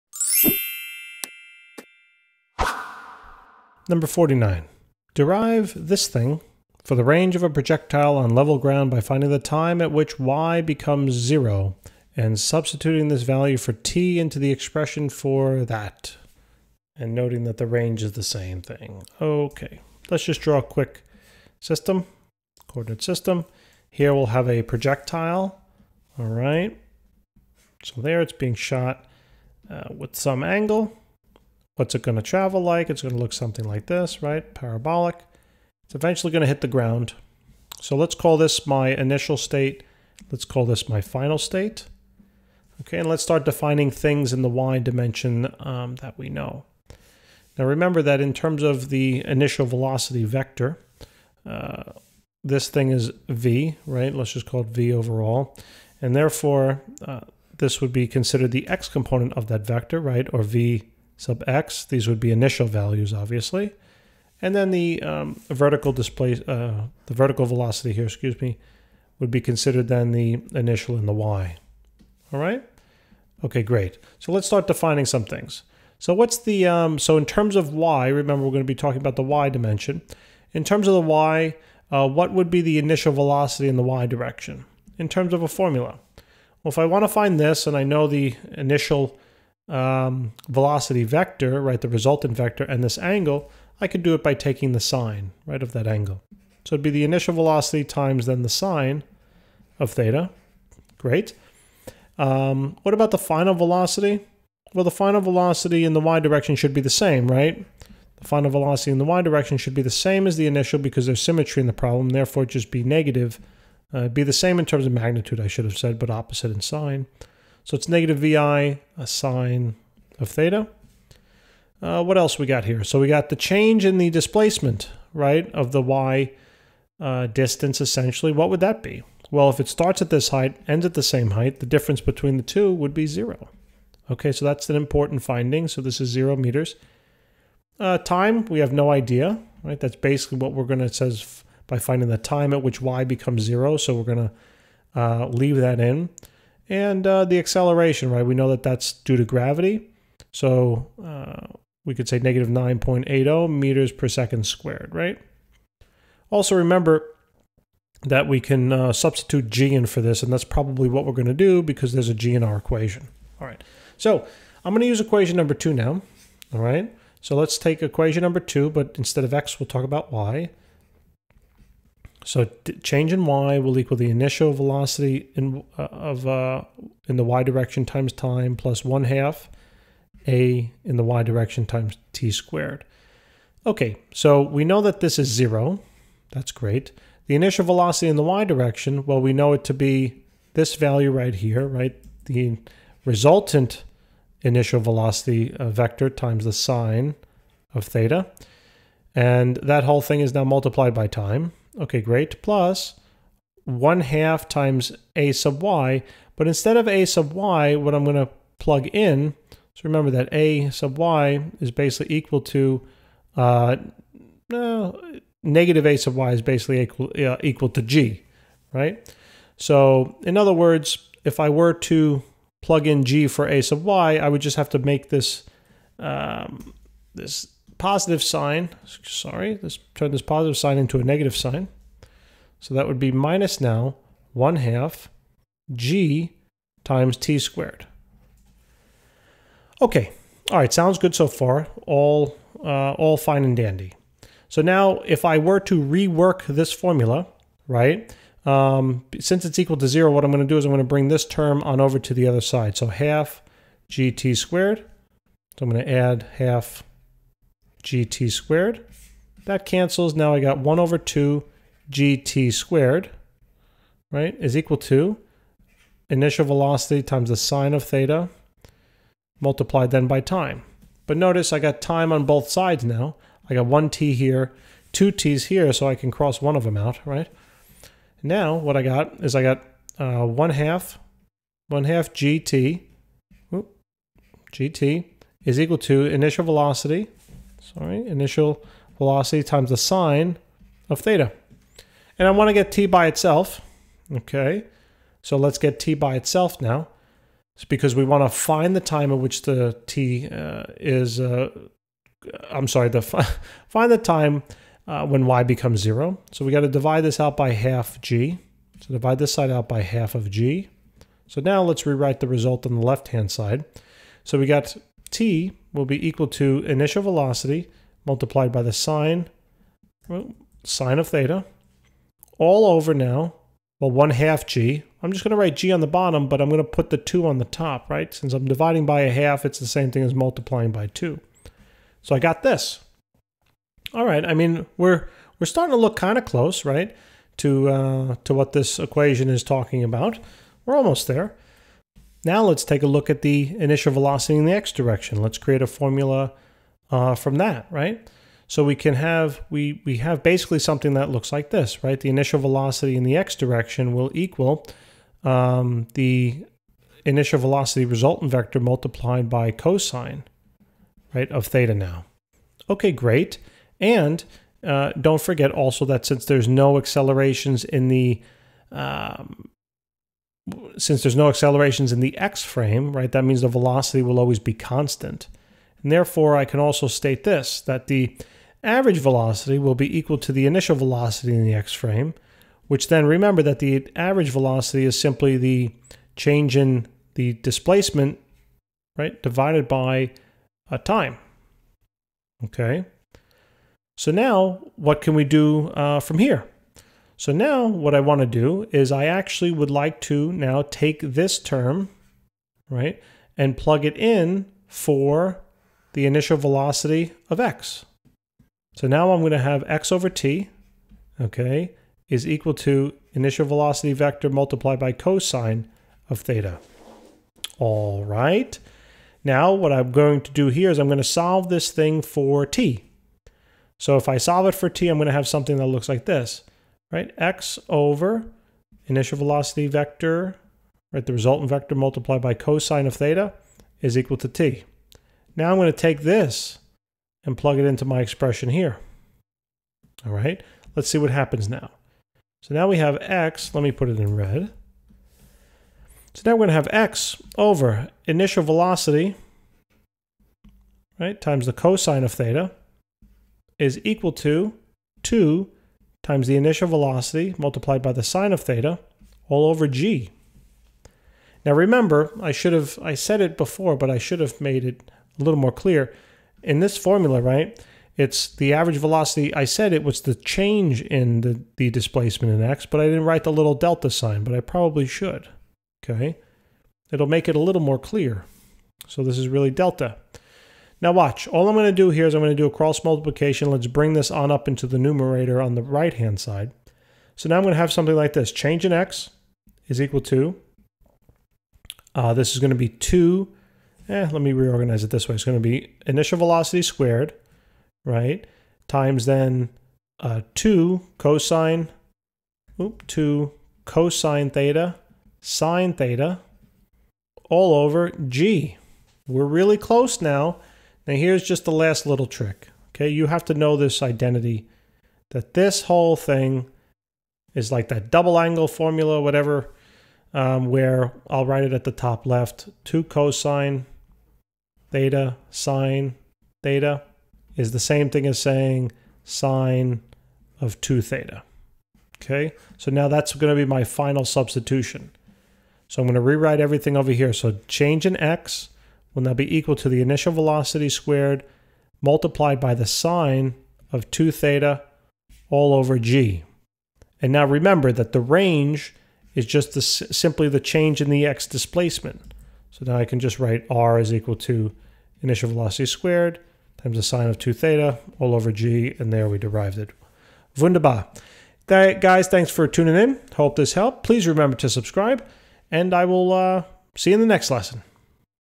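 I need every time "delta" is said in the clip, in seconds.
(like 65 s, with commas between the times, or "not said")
473 s, 479 s.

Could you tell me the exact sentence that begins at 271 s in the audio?
But notice I got time on both sides now.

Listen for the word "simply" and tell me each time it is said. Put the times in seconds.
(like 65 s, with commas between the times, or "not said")
384 s, 549 s.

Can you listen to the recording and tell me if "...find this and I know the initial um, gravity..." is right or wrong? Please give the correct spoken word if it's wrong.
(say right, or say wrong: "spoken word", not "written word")
wrong: "velocity", not "gravity".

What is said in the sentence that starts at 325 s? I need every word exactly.
I'm just going to write g on the bottom, but I'm going to put the 2 on the top, right?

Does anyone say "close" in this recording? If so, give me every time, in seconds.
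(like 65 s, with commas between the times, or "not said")
336 s, 509 s.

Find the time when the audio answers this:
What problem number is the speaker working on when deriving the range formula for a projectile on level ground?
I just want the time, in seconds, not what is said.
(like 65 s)
3 s.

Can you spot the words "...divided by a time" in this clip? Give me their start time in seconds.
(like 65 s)
389 s.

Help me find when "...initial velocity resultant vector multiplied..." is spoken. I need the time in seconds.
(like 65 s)
357 s.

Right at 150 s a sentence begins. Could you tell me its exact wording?
So uh, we could say negative 9.80 meters per second squared, right?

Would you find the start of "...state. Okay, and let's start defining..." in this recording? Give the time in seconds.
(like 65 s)
41 s.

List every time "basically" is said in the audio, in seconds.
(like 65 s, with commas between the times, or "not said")
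139 s, 211 s, 216 s, 350 s.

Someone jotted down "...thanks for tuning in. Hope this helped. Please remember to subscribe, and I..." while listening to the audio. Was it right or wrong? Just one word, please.
right.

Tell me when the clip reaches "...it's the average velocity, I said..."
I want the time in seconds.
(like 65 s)
467 s.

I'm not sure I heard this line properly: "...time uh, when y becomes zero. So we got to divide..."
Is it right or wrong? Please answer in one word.
right.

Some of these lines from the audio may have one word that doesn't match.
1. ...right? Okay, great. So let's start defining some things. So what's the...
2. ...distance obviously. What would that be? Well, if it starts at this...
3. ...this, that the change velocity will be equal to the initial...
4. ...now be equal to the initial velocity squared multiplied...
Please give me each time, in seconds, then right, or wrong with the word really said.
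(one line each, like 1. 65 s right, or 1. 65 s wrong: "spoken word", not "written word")
1. 72 s right
2. 127 s wrong: "essentially", not "obviously"
3. 377 s wrong: "average", not "change"
4. 539 s right.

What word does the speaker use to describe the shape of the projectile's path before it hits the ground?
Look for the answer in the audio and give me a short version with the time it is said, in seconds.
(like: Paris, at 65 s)
Parabolic, at 34 s.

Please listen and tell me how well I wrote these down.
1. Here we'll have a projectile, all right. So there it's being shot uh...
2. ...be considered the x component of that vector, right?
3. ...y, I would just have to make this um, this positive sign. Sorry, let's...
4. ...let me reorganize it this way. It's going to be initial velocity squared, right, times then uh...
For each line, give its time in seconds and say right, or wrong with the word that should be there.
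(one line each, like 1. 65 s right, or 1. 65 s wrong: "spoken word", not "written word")
1. 23 s right
2. 57 s right
3. 223 s right
4. 494 s right.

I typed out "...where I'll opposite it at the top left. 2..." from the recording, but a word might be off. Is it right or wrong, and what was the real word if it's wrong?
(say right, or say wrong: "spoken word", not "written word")
wrong: "write", not "opposite".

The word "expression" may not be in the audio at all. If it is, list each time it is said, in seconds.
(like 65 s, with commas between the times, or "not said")
14 s, 438 s.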